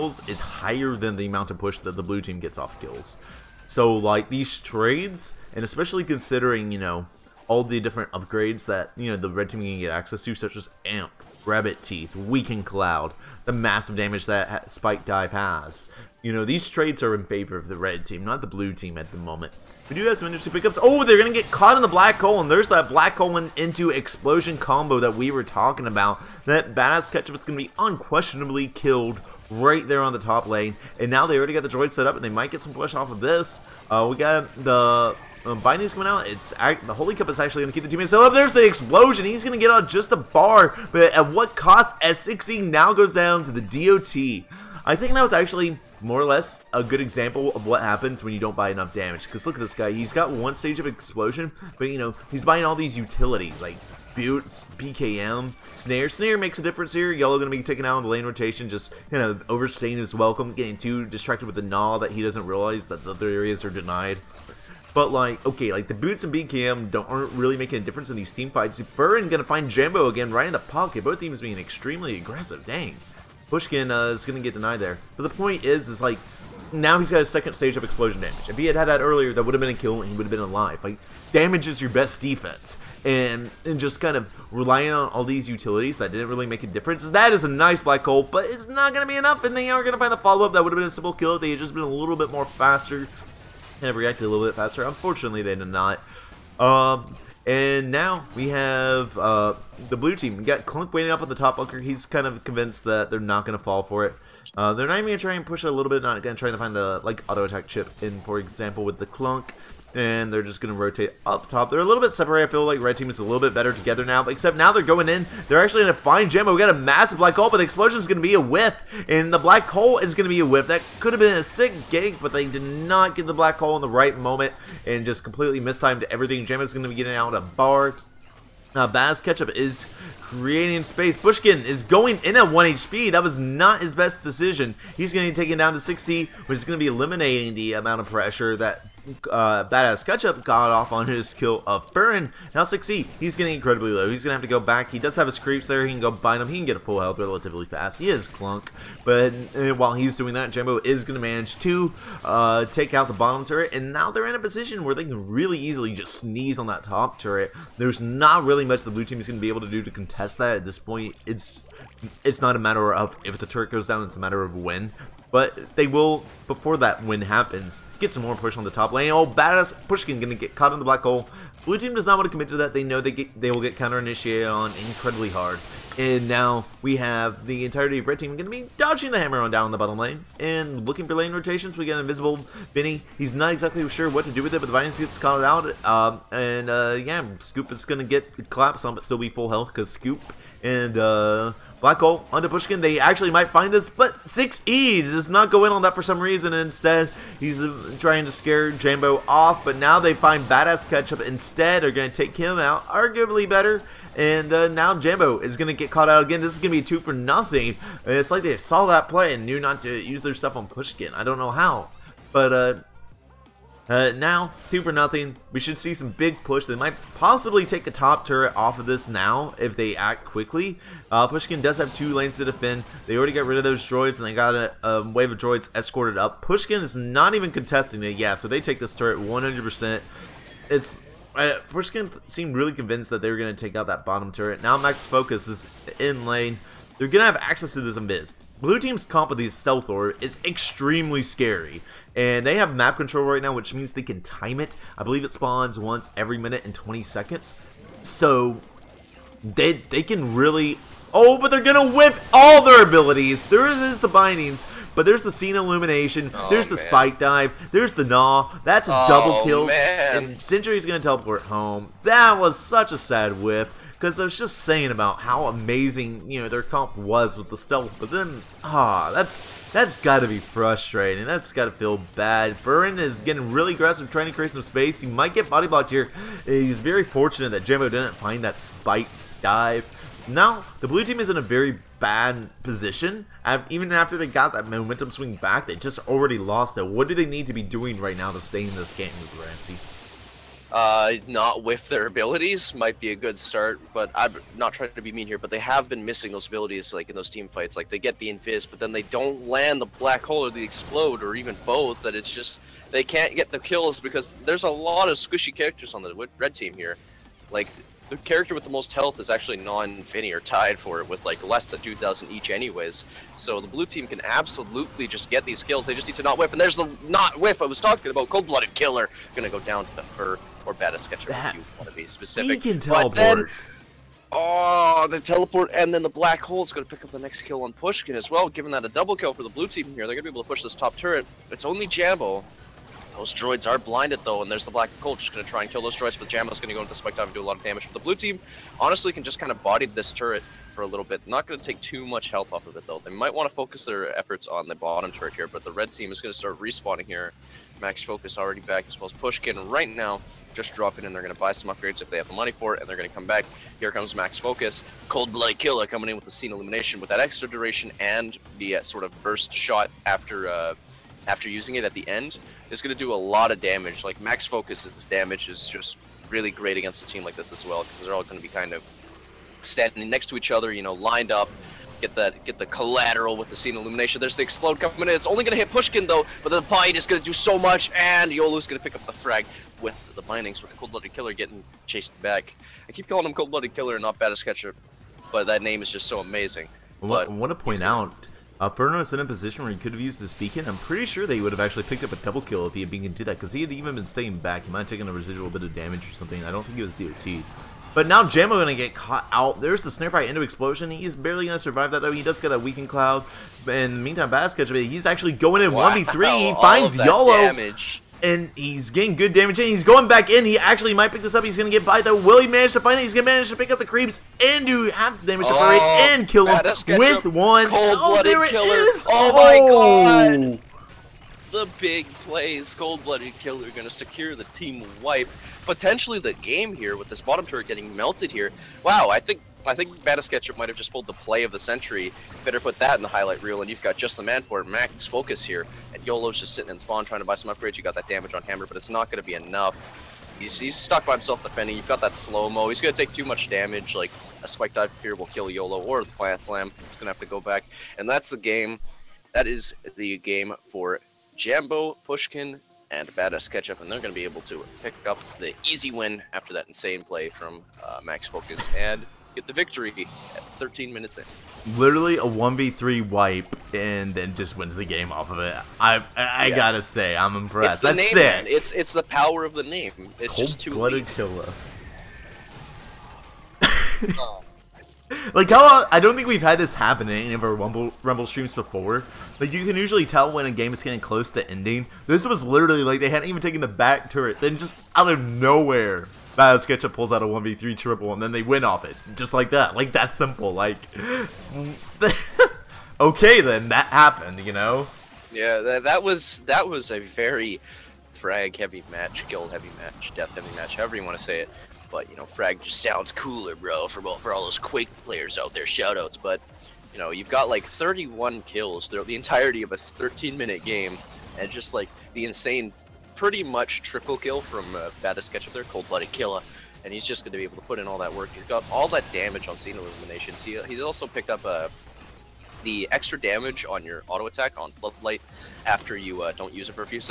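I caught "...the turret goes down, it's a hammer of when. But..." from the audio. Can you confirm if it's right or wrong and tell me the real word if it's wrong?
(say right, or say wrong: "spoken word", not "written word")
wrong: "matter", not "hammer".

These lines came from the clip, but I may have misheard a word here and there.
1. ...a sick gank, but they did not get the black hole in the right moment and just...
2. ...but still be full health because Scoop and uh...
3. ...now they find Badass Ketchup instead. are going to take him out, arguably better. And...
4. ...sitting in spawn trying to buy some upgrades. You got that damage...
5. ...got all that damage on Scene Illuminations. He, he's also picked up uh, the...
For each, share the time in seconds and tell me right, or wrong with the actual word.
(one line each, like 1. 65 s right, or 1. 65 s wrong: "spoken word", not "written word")
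1. 121 s right
2. 188 s right
3. 199 s right
4. 436 s right
5. 518 s right.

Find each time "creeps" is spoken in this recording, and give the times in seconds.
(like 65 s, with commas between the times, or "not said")
145 s, 413 s.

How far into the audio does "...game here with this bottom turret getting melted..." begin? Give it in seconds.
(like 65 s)
426 s.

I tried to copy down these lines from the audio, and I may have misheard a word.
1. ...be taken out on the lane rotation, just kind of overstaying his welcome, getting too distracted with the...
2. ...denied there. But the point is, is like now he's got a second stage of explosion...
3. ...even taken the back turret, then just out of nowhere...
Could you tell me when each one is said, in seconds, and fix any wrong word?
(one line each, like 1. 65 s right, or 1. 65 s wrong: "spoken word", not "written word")
1. 57 s right
2. 74 s right
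3. 483 s right.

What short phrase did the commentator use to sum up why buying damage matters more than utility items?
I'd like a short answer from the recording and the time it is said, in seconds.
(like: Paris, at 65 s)
damage is your best defense, at 81 s.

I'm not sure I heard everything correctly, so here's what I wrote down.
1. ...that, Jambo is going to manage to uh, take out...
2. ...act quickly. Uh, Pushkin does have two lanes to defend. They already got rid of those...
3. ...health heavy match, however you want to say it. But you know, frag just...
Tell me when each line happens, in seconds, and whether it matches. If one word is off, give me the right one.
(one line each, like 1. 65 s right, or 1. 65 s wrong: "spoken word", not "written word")
1. 150 s right
2. 219 s right
3. 500 s wrong: "death", not "health".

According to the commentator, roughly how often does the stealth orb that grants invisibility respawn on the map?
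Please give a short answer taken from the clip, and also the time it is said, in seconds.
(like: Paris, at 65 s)
every 1 minute 20 seconds, at 245 s.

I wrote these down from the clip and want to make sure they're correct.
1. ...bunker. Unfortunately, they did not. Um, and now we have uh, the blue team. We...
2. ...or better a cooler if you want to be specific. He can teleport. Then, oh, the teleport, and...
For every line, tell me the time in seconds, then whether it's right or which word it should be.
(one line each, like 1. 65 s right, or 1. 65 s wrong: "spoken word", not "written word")
1. 94 s wrong: "faster", not "bunker"
2. 320 s wrong: "sketcher", not "cooler".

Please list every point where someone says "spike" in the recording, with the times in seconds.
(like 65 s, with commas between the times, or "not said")
14 s, 256 s, 278 s, 336 s, 444 s.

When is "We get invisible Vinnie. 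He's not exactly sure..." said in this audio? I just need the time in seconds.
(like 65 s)
181 s.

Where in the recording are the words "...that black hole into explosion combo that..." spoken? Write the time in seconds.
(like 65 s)
22 s.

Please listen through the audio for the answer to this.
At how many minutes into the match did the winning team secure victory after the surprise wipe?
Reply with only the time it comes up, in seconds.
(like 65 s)
460 s.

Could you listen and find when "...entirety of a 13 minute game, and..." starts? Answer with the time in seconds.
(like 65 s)
509 s.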